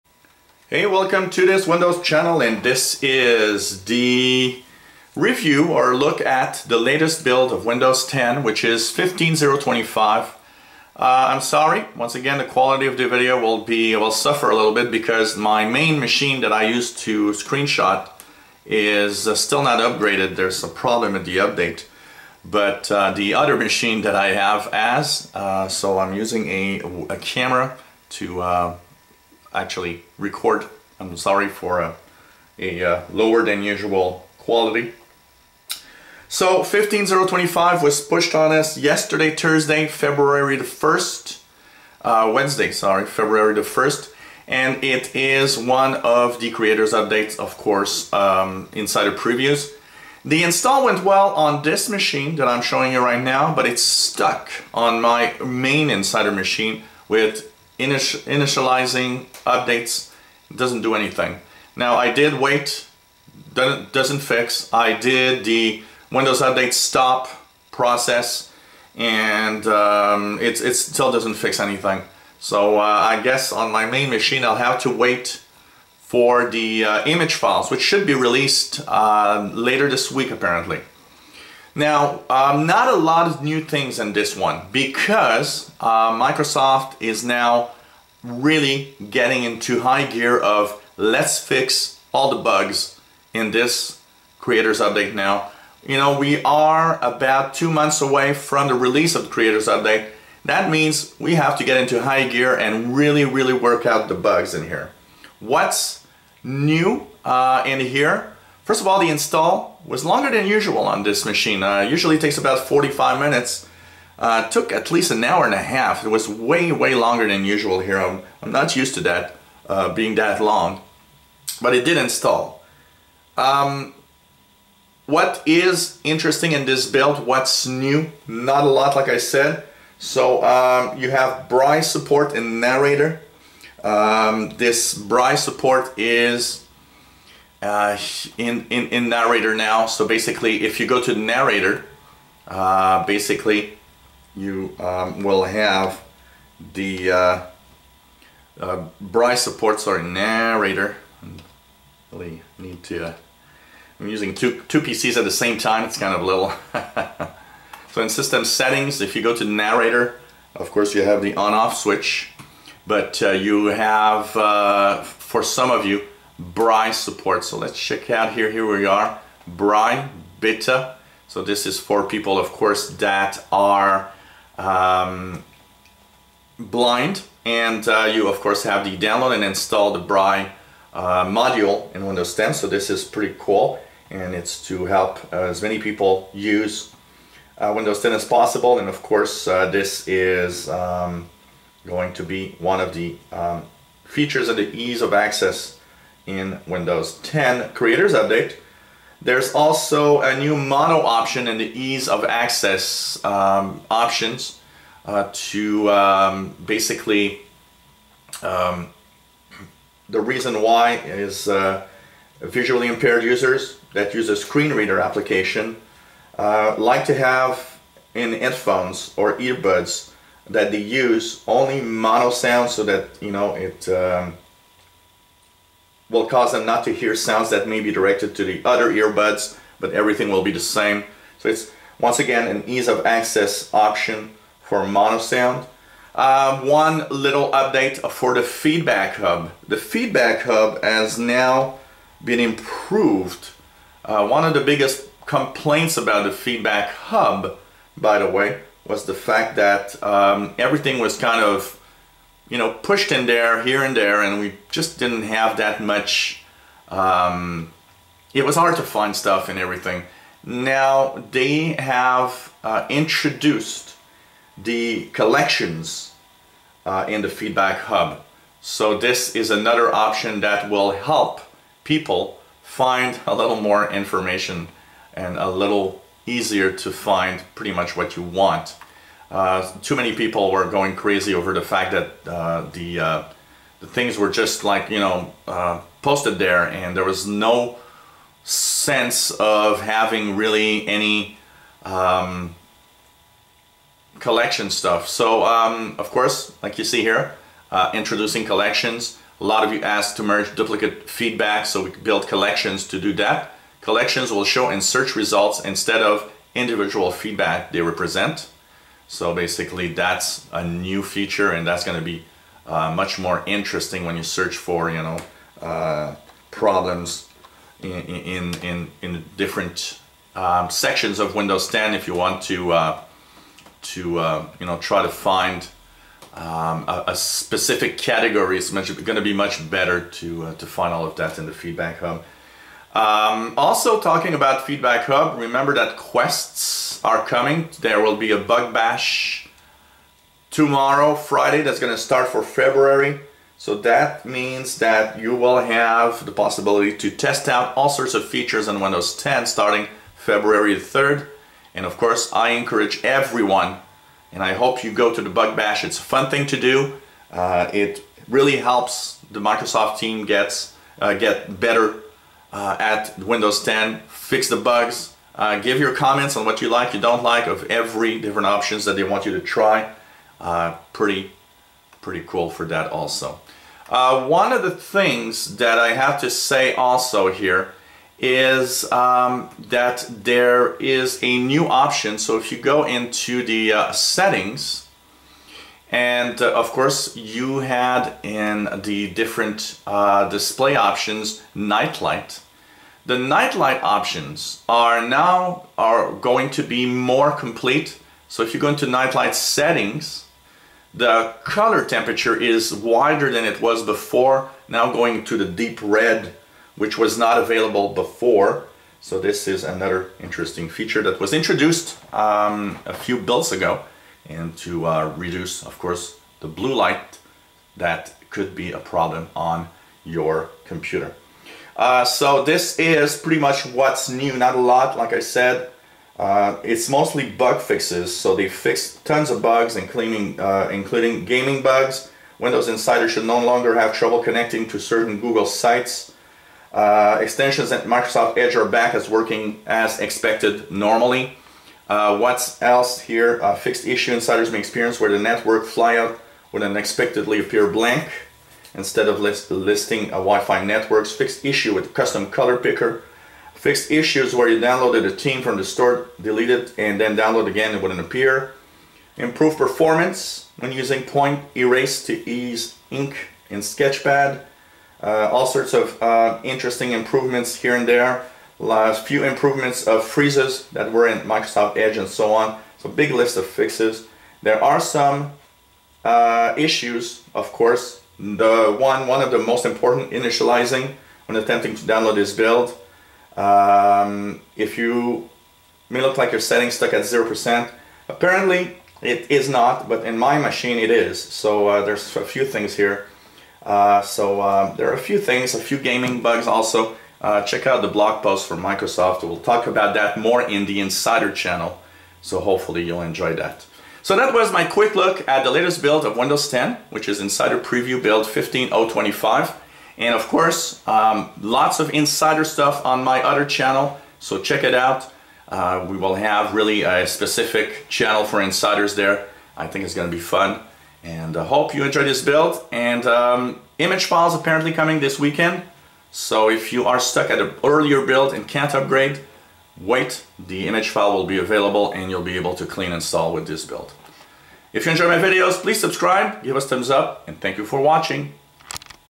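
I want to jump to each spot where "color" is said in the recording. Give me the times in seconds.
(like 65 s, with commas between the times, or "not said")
401 s, 452 s.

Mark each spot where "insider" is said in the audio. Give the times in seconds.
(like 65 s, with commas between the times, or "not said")
48 s, 55 s, 432 s, 444 s, 500 s, 507 s, 511 s, 518 s.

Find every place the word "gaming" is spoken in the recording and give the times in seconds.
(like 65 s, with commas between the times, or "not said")
431 s, 495 s.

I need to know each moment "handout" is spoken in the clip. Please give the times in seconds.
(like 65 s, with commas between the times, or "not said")
not said.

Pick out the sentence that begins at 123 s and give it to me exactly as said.
Um, what is interesting in this build?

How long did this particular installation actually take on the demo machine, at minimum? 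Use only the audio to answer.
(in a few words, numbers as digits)
an hour and a half.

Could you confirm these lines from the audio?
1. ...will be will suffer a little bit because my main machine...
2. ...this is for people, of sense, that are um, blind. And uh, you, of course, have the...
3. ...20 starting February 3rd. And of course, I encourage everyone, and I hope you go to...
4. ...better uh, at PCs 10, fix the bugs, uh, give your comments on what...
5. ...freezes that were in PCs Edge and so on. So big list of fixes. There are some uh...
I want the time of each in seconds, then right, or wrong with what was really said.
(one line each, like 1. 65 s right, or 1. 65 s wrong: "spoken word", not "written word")
1. 13 s right
2. 171 s wrong: "course", not "sense"
3. 349 s wrong: "10", not "20"
4. 361 s wrong: "Windows", not "PCs"
5. 470 s wrong: "Microsoft", not "PCs".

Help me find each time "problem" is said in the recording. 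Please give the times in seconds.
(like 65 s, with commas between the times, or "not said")
20 s, 316 s, 418 s.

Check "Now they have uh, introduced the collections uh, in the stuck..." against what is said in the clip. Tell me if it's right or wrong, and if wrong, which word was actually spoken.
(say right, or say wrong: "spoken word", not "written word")
wrong: "feedback", not "stuck".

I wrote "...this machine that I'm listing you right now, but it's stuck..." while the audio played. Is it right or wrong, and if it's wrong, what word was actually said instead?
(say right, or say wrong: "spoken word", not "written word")
wrong: "showing", not "listing".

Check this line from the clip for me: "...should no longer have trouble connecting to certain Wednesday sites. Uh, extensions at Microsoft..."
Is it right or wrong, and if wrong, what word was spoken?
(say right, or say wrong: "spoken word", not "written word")
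wrong: "Google", not "Wednesday".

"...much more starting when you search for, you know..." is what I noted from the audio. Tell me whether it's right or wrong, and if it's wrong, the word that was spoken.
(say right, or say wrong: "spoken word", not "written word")
wrong: "interesting", not "starting".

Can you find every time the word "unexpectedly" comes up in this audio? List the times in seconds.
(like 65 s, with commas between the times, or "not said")
446 s.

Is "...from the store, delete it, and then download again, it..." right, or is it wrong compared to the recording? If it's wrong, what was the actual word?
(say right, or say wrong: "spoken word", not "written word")
right.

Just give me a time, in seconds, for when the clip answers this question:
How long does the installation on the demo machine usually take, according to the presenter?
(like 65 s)
112 s.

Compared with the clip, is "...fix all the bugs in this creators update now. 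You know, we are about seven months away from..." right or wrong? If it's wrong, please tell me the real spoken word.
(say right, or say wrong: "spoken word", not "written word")
wrong: "two", not "seven".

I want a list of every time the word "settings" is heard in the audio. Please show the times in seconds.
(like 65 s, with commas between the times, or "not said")
158 s, 383 s, 399 s, 486 s.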